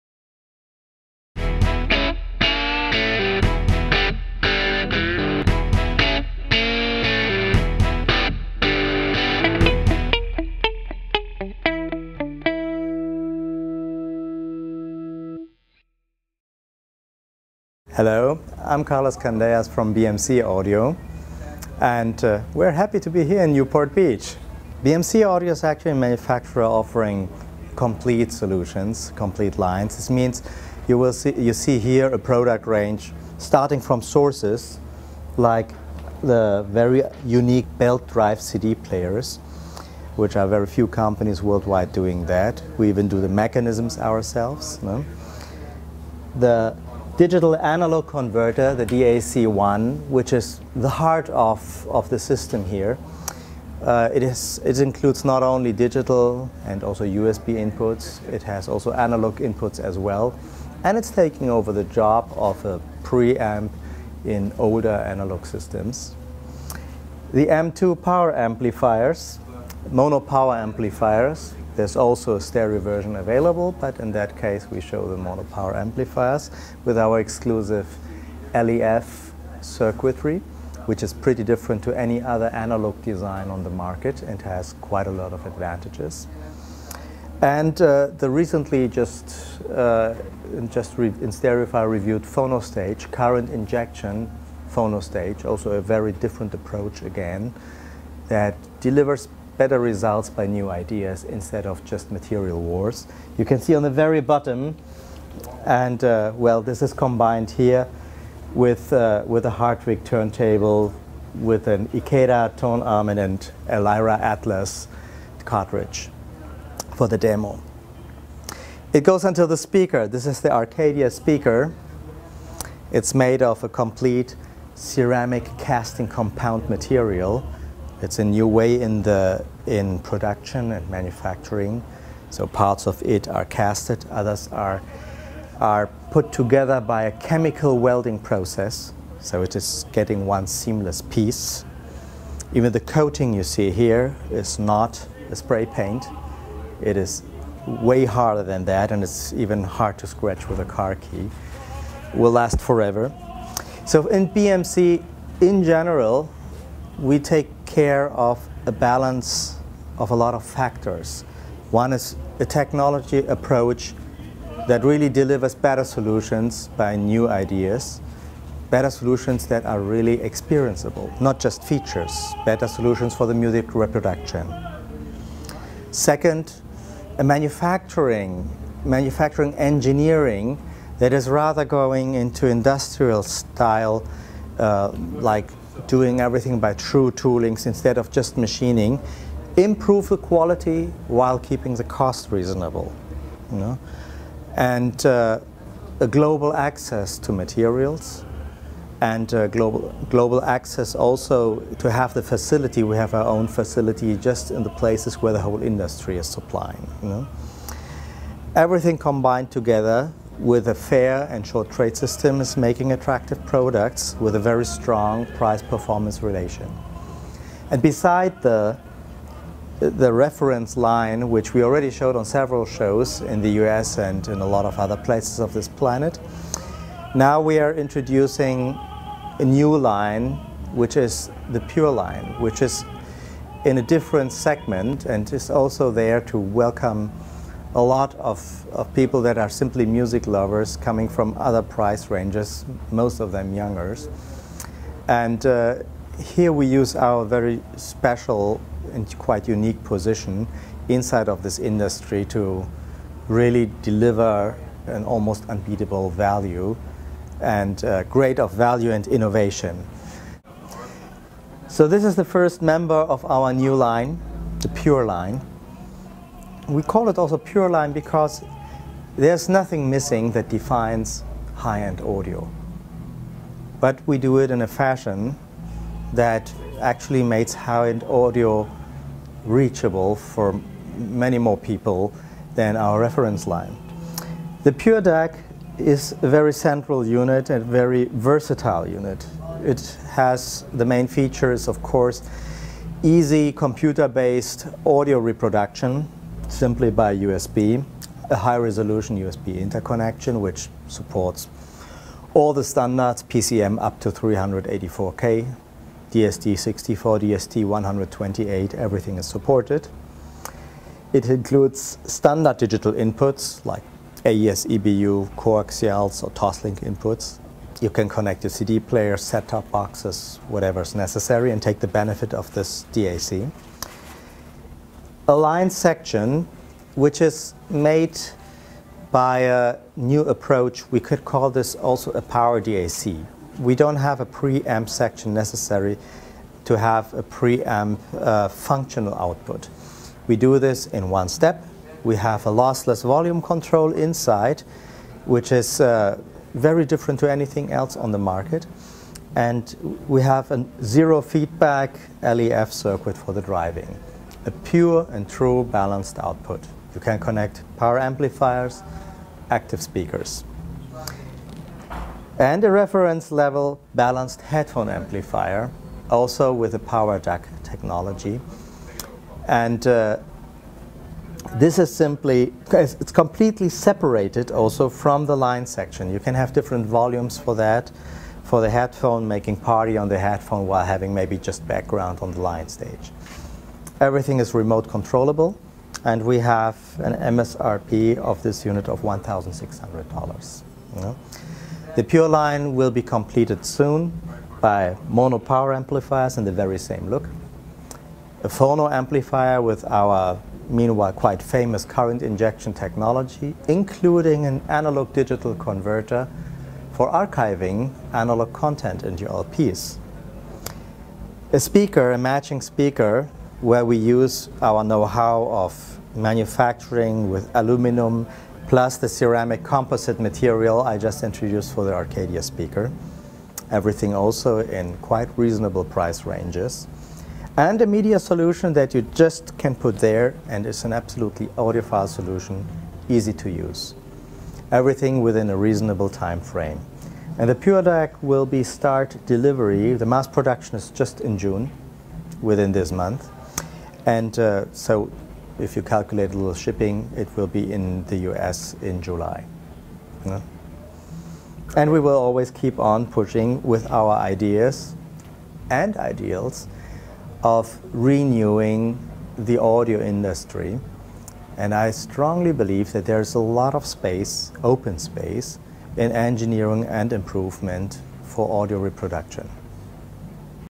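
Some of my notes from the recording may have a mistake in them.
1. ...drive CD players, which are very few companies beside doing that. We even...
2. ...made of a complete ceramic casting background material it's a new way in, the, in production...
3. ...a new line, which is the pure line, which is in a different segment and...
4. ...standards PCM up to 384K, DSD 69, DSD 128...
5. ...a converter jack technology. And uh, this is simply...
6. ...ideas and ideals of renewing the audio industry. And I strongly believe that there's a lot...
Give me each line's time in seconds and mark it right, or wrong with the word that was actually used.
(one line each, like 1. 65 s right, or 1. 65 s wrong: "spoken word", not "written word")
1. 38 s wrong: "worldwide", not "beside"
2. 123 s wrong: "compound", not "background"
3. 229 s right
4. 302 s wrong: "64", not "69"
5. 366 s wrong: "power", not "converter"
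6. 454 s right.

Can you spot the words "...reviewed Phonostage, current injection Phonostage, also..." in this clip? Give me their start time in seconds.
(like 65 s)
91 s.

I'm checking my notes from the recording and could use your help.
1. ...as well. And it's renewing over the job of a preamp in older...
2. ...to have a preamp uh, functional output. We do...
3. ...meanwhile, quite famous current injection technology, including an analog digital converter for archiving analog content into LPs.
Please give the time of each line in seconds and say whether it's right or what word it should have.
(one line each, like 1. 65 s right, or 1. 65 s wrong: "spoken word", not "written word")
1. 59 s wrong: "taking", not "renewing"
2. 336 s right
3. 400 s right.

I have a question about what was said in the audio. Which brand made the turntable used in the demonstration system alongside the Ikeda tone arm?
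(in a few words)
Hartvig.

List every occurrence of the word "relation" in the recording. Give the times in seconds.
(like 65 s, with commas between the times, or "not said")
216 s.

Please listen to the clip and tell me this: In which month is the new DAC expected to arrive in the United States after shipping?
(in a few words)
July.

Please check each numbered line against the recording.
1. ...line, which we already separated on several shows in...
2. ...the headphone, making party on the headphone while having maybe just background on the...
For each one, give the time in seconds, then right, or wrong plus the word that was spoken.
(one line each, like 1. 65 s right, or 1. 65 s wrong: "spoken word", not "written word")
1. 220 s wrong: "showed", not "separated"
2. 378 s right.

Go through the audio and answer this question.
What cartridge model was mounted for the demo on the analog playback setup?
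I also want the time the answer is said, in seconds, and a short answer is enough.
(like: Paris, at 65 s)
Lyra Atlas, at 113 s.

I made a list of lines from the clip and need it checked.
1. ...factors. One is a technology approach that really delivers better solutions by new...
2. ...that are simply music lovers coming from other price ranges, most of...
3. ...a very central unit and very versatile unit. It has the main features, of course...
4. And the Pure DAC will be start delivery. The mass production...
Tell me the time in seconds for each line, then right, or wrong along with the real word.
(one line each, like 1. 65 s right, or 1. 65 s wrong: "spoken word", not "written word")
1. 160 s right
2. 239 s right
3. 286 s right
4. 437 s right.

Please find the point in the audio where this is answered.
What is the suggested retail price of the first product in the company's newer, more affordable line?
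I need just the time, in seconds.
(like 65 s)
389 s.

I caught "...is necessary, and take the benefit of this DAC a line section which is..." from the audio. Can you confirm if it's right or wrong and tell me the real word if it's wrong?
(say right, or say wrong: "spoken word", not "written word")
right.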